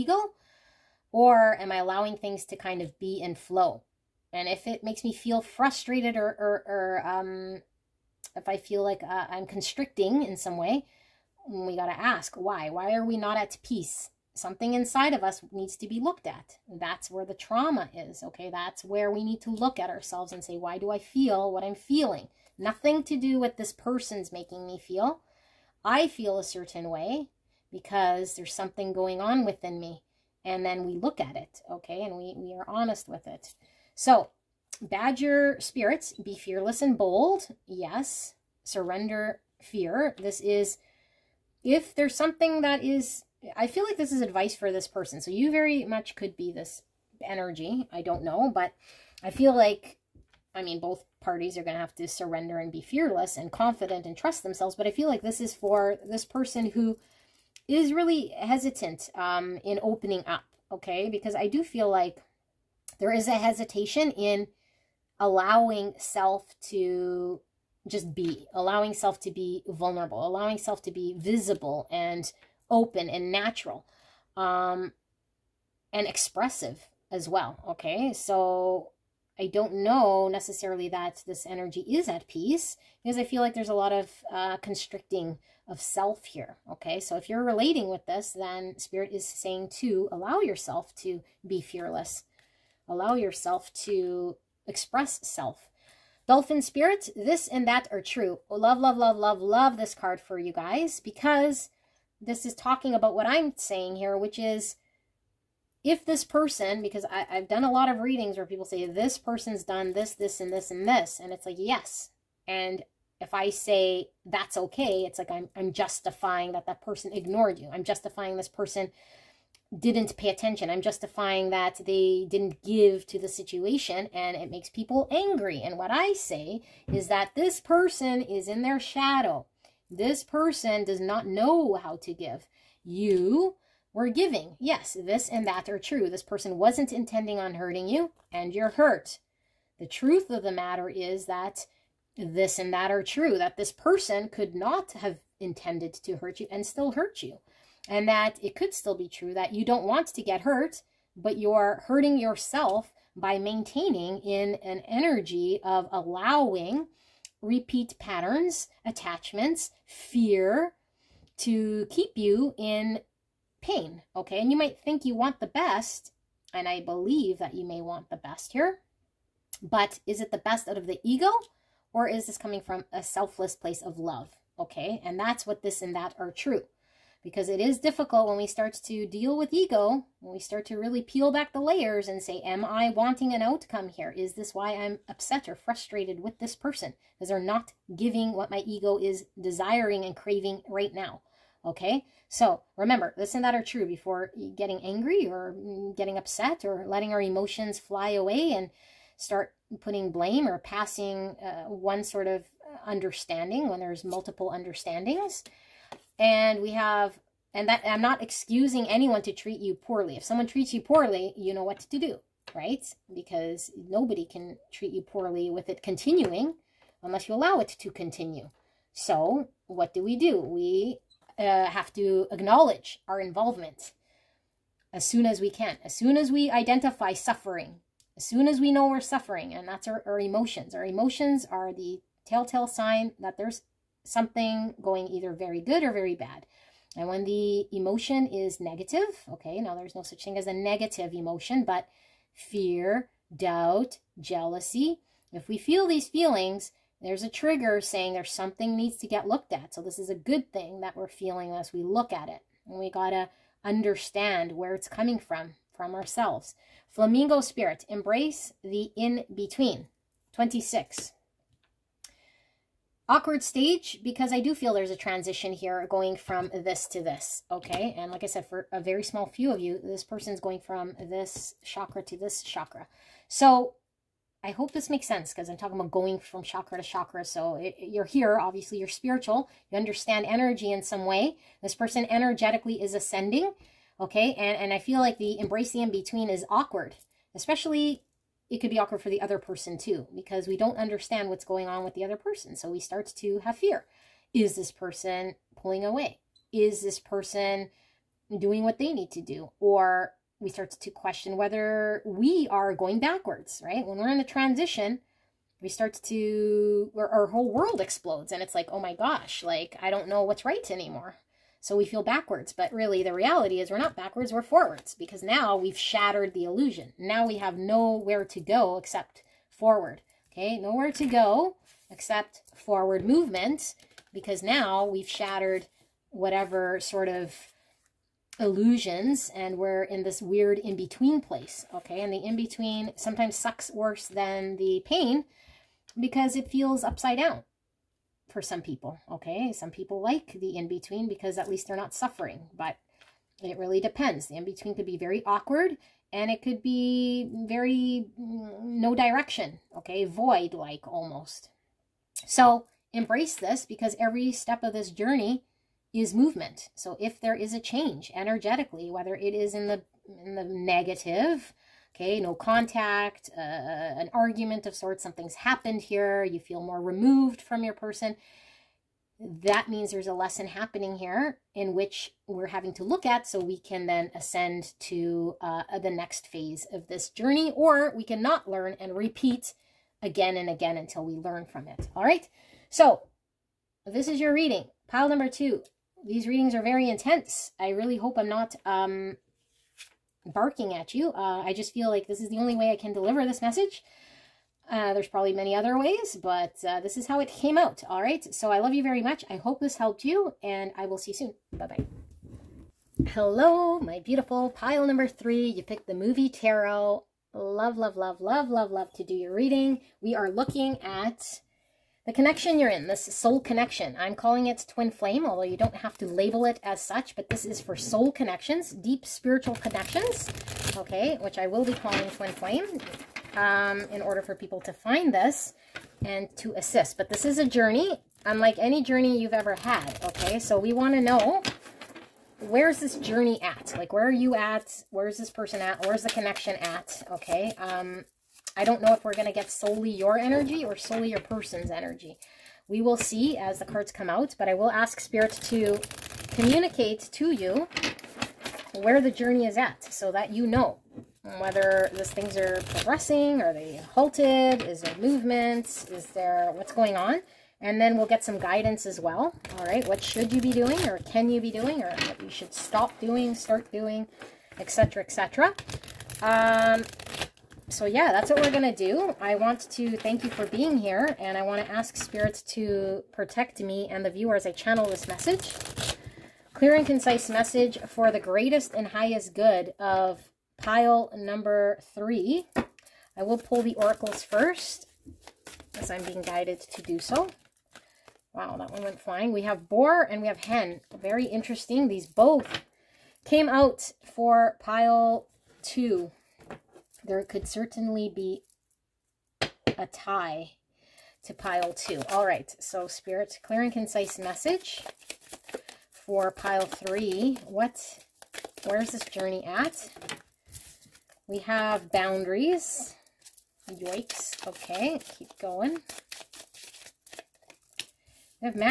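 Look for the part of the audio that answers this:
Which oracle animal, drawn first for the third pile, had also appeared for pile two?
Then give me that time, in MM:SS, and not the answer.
08:09.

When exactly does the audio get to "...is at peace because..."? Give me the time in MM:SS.
01:21.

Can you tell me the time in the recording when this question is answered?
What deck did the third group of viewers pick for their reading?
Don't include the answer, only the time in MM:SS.
06:45.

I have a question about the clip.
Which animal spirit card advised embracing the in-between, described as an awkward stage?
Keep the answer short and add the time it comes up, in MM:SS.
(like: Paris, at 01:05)
Flamingo, at 04:16.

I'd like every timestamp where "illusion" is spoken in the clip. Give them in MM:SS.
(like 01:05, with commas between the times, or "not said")
05:16, 05:28.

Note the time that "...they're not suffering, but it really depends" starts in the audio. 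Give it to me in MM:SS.
05:41.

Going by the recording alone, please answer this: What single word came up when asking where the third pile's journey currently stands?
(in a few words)
boundaries.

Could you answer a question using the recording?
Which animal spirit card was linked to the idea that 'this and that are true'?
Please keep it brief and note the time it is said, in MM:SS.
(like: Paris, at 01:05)
Dolphin, at 01:36.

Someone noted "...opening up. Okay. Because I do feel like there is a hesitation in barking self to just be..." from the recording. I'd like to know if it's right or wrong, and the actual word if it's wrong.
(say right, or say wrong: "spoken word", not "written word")
wrong: "allowing", not "barking".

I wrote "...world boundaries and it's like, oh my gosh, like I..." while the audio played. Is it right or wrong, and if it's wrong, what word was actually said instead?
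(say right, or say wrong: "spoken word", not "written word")
wrong: "explodes", not "boundaries".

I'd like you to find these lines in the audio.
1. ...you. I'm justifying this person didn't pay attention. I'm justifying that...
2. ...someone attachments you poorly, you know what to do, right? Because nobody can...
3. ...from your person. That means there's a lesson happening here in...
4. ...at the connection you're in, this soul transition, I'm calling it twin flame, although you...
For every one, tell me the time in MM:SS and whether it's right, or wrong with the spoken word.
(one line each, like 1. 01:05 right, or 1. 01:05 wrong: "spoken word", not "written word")
1. 01:57 right
2. 03:30 wrong: "treats", not "attachments"
3. 06:07 right
4. 06:50 wrong: "connection", not "transition".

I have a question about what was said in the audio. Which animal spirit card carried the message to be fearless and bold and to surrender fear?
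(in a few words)
Badger.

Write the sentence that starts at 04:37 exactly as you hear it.
So it, you're here, obviously you're spiritual.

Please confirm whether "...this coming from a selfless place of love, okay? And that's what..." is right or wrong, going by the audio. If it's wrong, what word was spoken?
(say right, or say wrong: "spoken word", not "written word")
right.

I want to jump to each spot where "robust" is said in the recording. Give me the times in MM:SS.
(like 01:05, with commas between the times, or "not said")
not said.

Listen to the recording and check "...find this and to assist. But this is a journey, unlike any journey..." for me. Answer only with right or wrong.
right.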